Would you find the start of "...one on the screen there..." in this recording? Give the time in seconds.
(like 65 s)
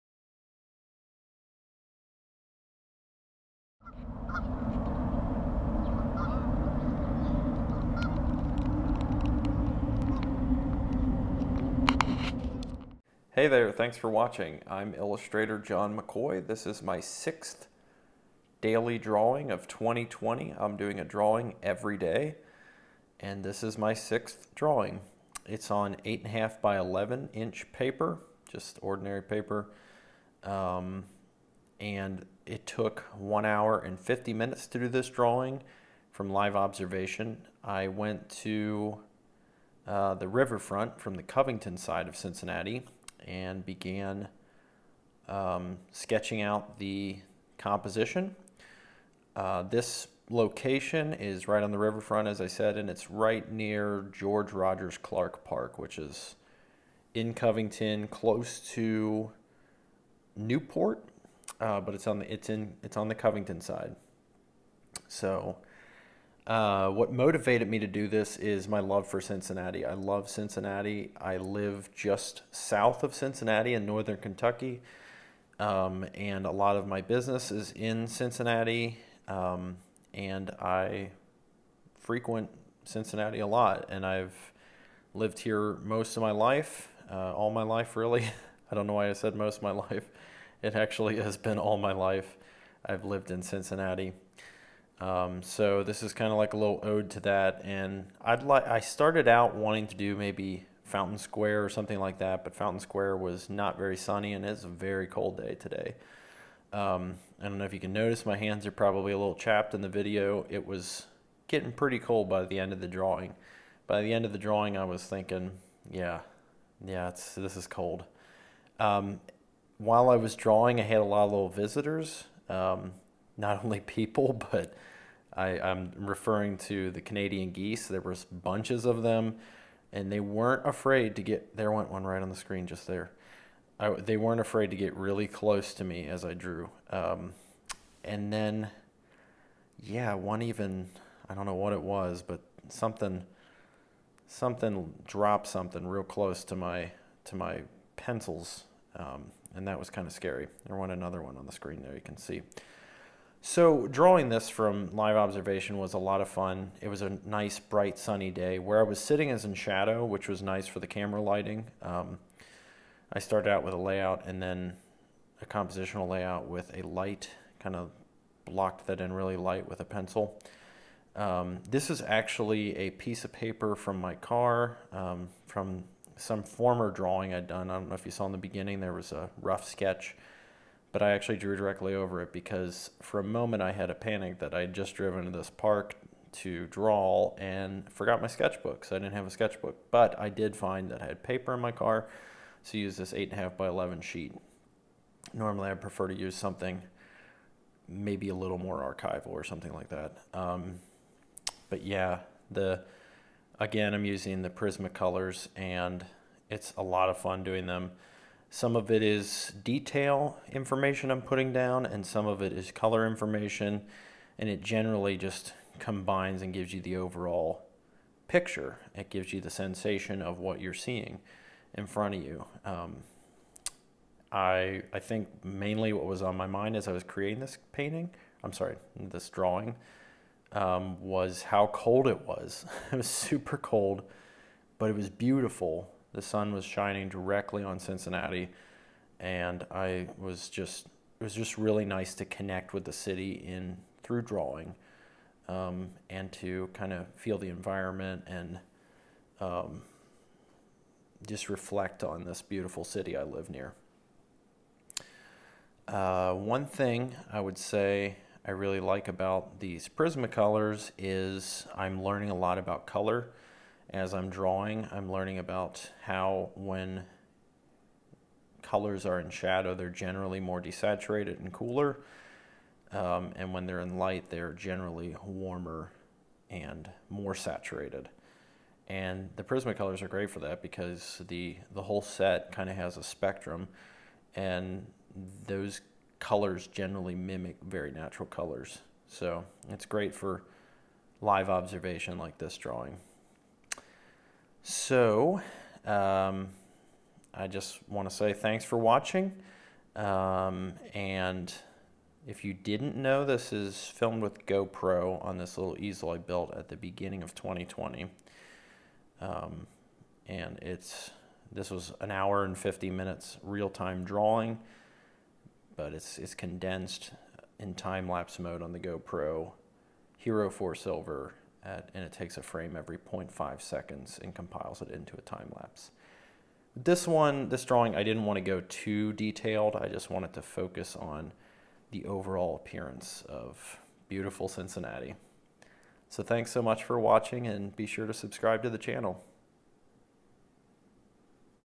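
151 s.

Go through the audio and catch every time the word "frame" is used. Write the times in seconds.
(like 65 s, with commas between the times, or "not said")
322 s.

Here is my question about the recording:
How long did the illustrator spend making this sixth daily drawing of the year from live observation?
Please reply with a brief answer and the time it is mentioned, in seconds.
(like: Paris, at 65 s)
1 hour 50 minutes, at 33 s.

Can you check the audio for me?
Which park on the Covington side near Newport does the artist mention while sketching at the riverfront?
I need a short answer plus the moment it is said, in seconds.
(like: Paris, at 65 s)
George Rogers Clark Park, at 54 s.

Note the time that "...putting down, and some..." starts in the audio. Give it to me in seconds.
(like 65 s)
211 s.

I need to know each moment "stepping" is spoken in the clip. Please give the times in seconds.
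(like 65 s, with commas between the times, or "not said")
not said.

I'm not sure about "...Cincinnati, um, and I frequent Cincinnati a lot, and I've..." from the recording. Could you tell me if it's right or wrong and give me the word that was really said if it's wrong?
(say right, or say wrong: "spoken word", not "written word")
right.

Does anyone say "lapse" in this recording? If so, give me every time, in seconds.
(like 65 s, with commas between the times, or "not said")
317 s, 325 s.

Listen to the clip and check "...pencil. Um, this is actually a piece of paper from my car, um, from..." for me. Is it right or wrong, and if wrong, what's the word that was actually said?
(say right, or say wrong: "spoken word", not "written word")
right.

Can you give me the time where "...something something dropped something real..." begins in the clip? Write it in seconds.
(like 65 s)
142 s.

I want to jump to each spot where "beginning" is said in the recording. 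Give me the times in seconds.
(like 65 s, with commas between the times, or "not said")
178 s, 306 s.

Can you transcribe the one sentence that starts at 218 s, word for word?
It gives you the sensation of what you're seeing in front of you.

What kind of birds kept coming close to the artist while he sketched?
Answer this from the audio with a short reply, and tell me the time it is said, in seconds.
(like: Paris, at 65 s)
Canadian geese, at 127 s.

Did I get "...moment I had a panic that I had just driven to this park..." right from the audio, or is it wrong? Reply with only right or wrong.
right.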